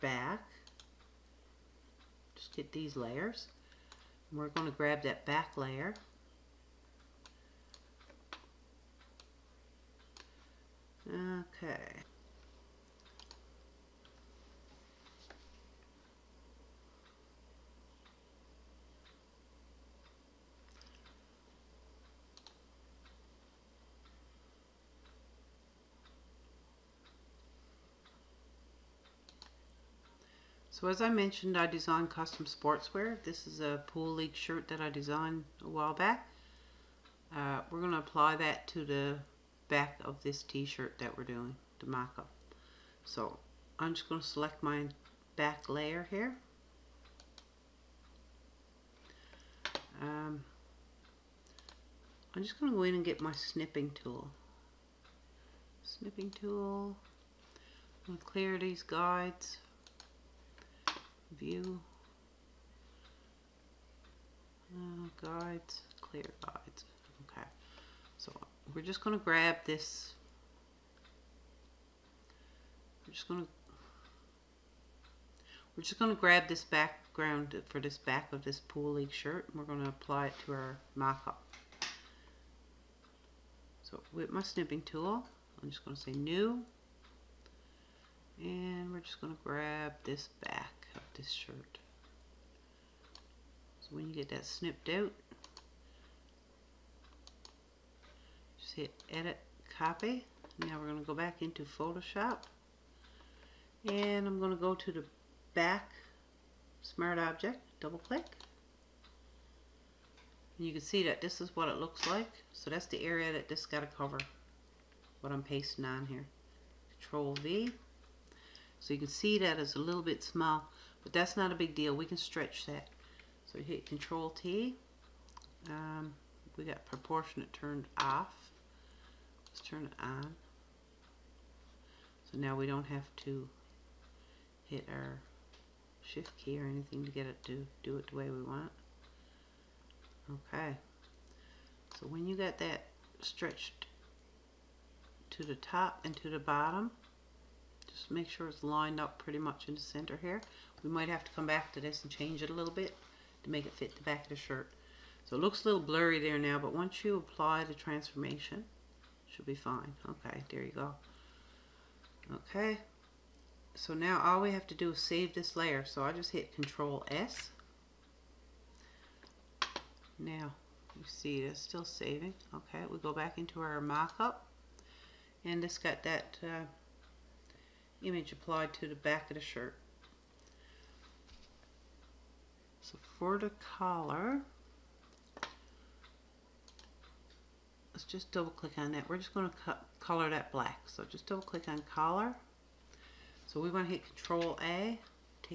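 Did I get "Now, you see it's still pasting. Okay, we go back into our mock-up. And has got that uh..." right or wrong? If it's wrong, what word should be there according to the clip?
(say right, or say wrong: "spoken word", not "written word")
wrong: "saving", not "pasting".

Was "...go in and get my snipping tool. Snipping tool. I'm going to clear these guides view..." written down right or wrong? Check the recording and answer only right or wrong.
right.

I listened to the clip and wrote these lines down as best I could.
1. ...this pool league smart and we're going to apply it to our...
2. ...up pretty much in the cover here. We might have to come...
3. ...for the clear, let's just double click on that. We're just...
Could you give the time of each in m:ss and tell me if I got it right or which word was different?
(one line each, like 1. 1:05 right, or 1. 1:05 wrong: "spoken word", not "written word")
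1. 1:18 wrong: "shirt", not "smart"
2. 2:28 wrong: "center", not "cover"
3. 3:03 wrong: "collar", not "clear".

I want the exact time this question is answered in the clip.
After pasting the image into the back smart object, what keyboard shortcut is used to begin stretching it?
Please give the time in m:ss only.
2:03.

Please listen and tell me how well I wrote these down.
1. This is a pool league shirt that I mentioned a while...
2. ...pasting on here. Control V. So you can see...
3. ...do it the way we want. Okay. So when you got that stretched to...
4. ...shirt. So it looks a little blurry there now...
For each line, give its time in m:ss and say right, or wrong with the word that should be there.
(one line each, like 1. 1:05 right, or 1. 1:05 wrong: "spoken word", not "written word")
1. 0:33 wrong: "designed", not "mentioned"
2. 1:55 right
3. 2:17 right
4. 2:34 right.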